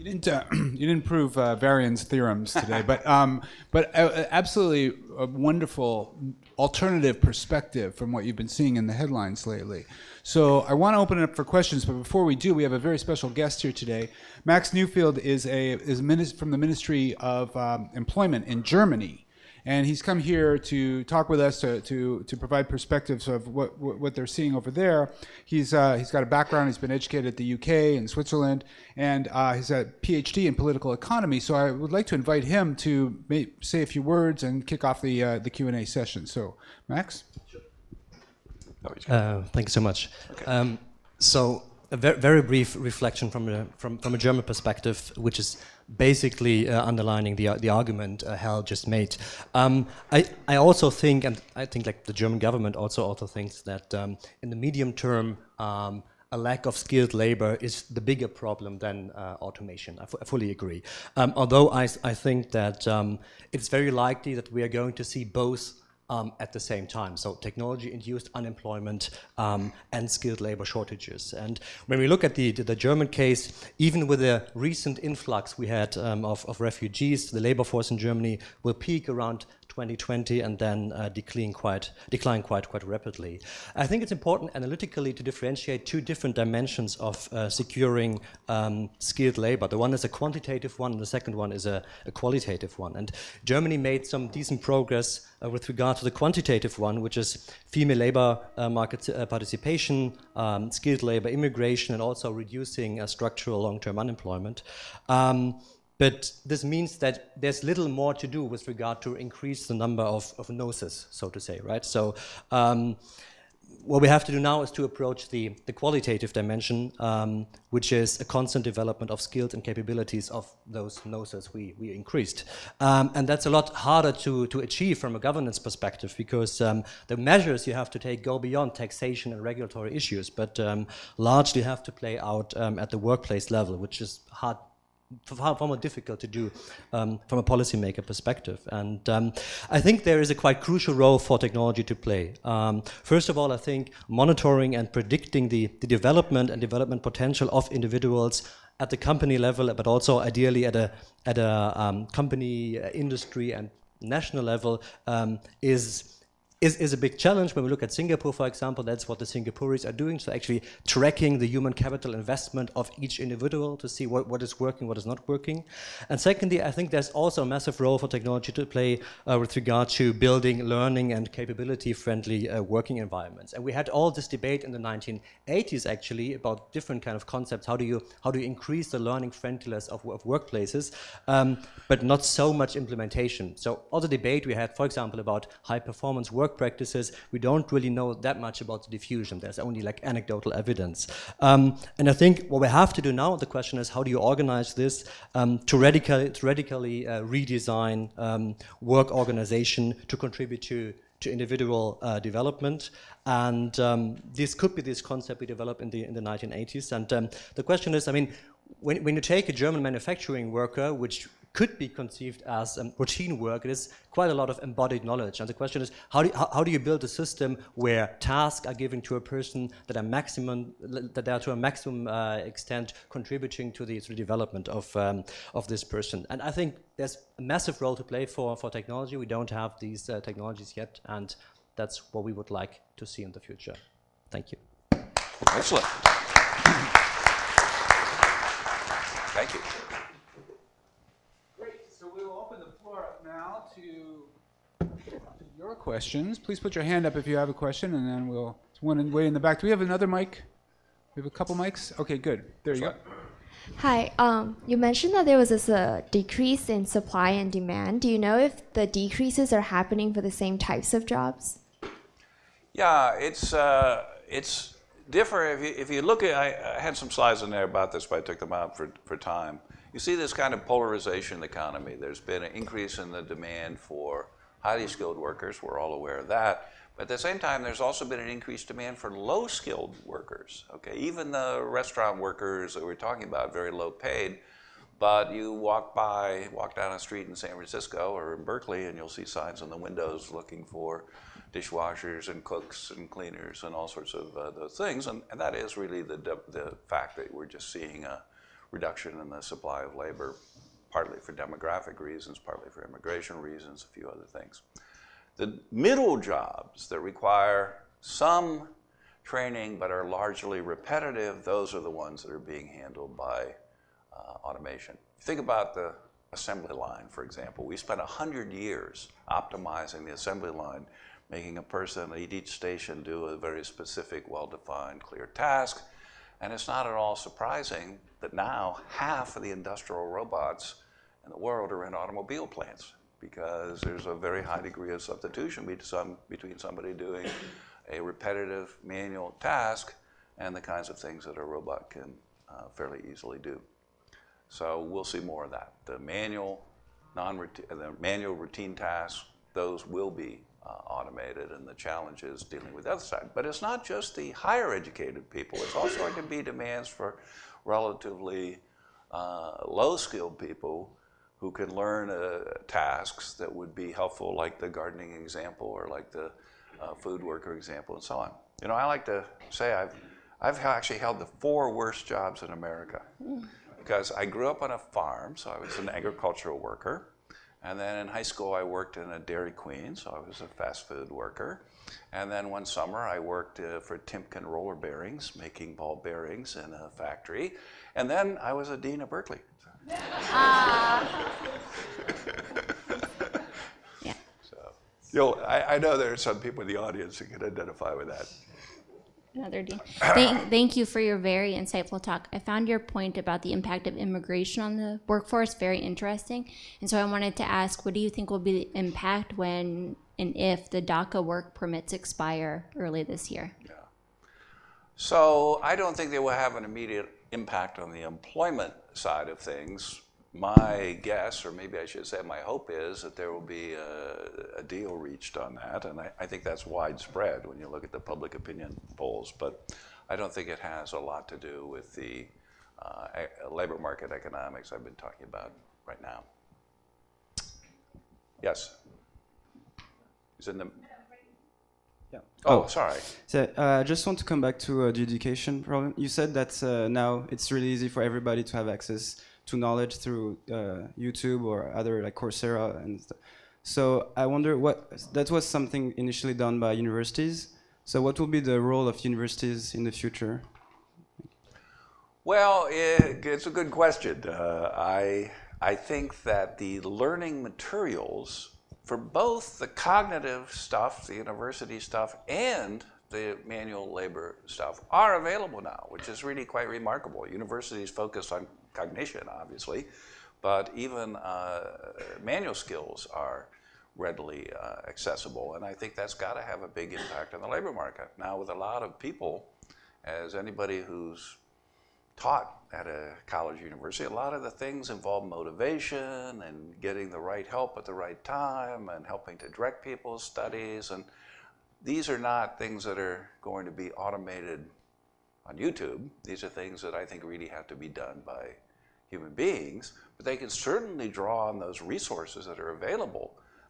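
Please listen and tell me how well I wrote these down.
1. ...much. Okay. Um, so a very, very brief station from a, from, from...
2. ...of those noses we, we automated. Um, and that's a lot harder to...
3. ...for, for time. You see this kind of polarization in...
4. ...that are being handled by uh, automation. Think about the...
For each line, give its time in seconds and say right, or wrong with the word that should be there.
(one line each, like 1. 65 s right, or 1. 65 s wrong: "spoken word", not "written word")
1. 39 s wrong: "reflection", not "station"
2. 120 s wrong: "increased", not "automated"
3. 268 s right
4. 312 s right.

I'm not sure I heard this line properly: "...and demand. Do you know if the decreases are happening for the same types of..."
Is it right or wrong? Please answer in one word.
right.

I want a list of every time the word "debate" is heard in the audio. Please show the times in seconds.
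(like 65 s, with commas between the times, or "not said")
174 s, 184 s.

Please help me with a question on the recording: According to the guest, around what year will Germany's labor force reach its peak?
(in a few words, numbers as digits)
2020.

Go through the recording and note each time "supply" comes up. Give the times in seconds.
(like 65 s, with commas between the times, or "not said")
256 s, 299 s.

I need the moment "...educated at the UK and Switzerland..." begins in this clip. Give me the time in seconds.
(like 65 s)
26 s.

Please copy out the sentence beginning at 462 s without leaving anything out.
Well, it, it's a good question.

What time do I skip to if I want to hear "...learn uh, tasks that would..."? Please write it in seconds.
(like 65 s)
361 s.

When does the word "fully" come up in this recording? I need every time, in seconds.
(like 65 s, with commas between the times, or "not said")
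60 s.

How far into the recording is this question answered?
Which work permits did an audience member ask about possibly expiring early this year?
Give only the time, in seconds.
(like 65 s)
410 s.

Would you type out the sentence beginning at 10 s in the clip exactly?
So I want to open it up for questions, but before we do, we have a very special guest here today.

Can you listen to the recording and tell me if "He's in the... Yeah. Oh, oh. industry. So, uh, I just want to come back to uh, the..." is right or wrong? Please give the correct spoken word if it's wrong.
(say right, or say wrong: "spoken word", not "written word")
wrong: "sorry", not "industry".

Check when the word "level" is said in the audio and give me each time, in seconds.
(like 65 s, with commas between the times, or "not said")
133 s, 149 s, 154 s.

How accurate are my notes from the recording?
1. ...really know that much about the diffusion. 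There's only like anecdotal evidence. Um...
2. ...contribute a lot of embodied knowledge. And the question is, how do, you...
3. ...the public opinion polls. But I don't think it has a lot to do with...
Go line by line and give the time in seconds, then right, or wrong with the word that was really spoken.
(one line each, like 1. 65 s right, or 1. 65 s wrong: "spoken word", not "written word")
1. 187 s right
2. 214 s wrong: "quite", not "contribute"
3. 427 s right.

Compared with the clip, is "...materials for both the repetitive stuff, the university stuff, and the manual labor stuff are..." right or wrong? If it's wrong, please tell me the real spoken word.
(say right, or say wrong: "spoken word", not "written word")
wrong: "cognitive", not "repetitive".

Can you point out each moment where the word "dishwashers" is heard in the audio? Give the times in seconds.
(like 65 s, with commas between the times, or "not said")
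291 s.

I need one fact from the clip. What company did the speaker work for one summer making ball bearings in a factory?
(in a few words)
Timken Roller Bearings.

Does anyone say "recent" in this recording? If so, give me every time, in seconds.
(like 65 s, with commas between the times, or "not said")
74 s.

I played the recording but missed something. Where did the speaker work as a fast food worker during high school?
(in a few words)
Dairy Queen.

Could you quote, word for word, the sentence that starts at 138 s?
And um, I think there is a quite crucial role for technology to play.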